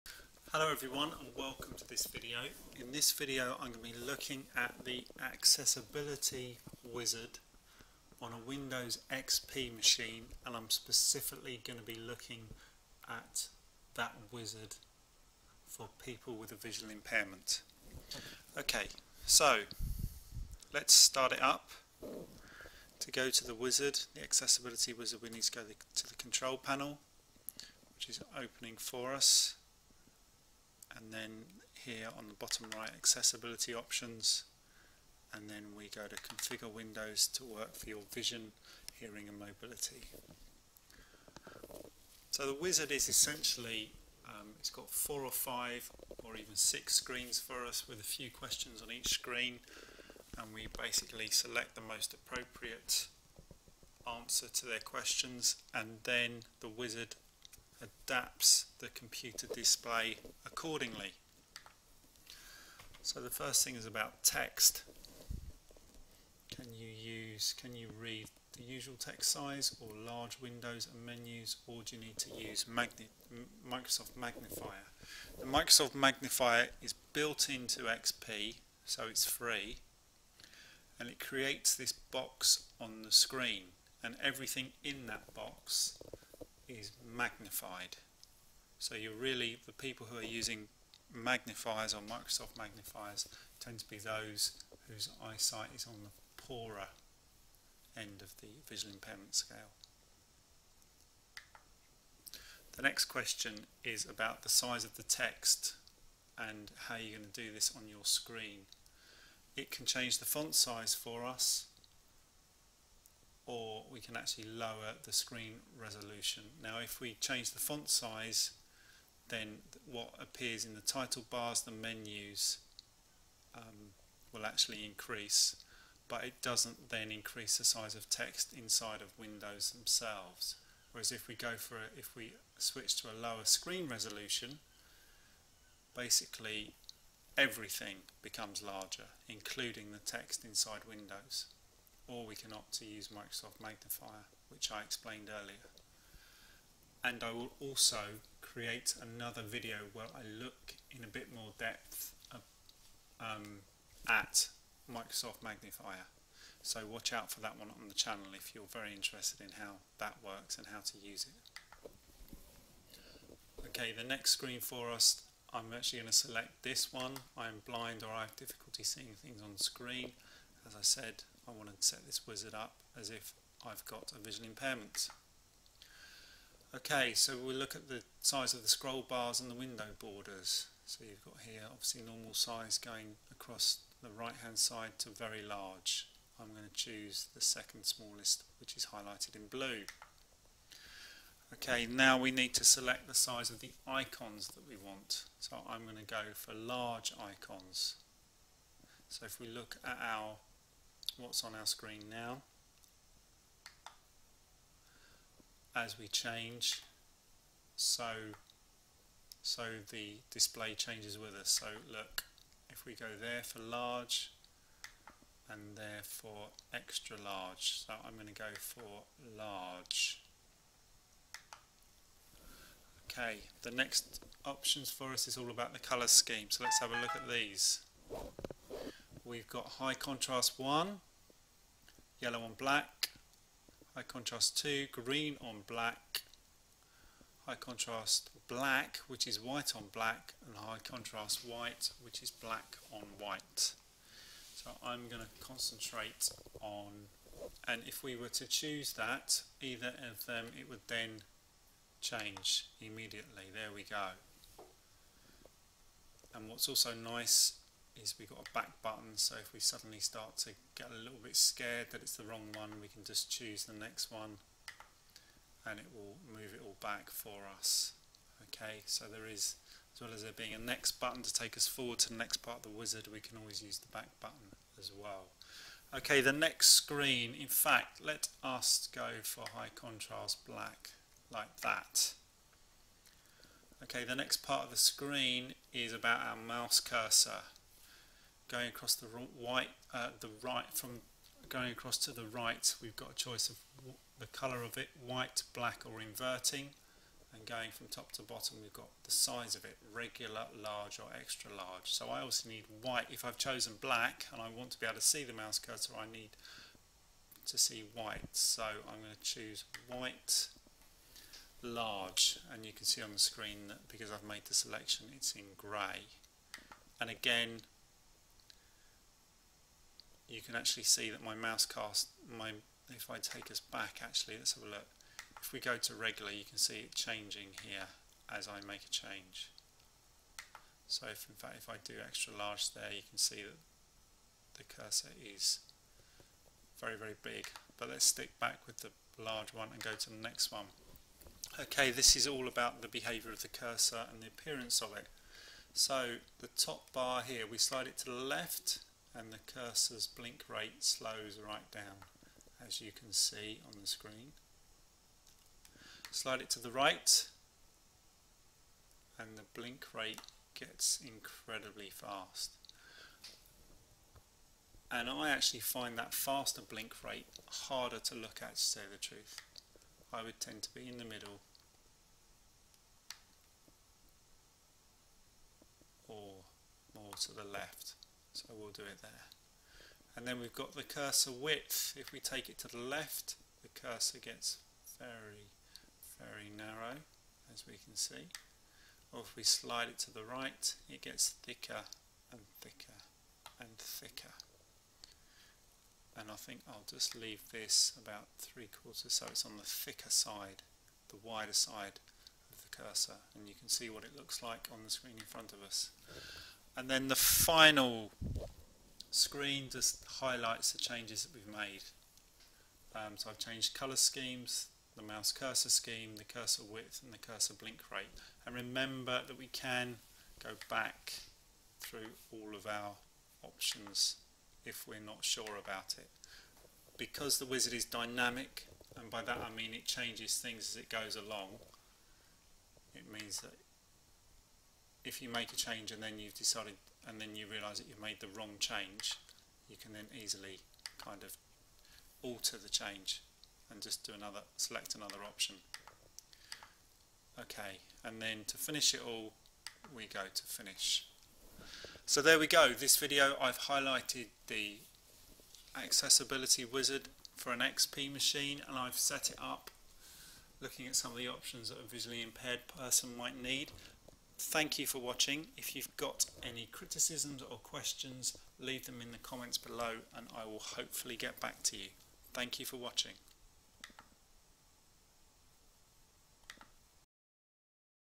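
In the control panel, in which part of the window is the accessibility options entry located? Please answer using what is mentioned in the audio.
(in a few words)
bottom right.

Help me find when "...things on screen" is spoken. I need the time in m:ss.
2:49.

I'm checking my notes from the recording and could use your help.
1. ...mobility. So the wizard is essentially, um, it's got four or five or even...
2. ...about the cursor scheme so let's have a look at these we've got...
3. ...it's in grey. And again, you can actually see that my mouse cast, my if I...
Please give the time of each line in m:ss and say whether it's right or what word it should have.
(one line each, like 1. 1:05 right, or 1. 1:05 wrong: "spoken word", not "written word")
1. 0:39 right
2. 3:45 wrong: "color", not "cursor"
3. 5:15 right.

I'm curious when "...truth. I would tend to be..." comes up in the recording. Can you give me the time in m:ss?
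6:08.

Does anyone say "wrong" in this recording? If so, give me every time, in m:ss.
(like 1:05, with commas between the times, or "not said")
4:22, 7:18.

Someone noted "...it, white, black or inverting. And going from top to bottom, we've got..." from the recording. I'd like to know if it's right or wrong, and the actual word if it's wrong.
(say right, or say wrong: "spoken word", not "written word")
right.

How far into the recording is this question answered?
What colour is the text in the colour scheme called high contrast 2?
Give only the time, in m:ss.
3:54.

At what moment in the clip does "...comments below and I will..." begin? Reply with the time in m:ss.
7:49.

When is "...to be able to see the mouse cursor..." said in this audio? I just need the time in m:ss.
5:04.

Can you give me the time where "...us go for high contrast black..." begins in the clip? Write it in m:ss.
4:38.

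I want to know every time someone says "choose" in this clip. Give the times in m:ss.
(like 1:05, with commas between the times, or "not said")
3:06, 4:08, 4:23, 5:09.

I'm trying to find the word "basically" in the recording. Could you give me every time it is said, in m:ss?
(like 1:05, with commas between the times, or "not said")
0:50, 2:15.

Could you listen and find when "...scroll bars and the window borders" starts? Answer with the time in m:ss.
2:58.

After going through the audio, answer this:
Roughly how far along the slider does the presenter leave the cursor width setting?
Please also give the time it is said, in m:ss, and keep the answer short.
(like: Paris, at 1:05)
three quarters, at 6:38.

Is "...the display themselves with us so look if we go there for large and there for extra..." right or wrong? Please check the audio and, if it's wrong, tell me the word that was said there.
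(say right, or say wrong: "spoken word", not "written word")
wrong: "changes", not "themselves".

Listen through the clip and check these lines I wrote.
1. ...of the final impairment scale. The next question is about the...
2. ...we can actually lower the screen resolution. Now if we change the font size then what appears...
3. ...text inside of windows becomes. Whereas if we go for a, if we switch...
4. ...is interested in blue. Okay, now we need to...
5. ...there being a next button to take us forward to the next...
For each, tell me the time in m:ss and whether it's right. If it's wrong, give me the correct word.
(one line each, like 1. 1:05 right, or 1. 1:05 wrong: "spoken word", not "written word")
1. 1:38 wrong: "visual", not "final"
2. 1:53 right
3. 2:08 wrong: "themselves", not "becomes"
4. 3:08 wrong: "highlighted", not "interested"
5. 4:30 right.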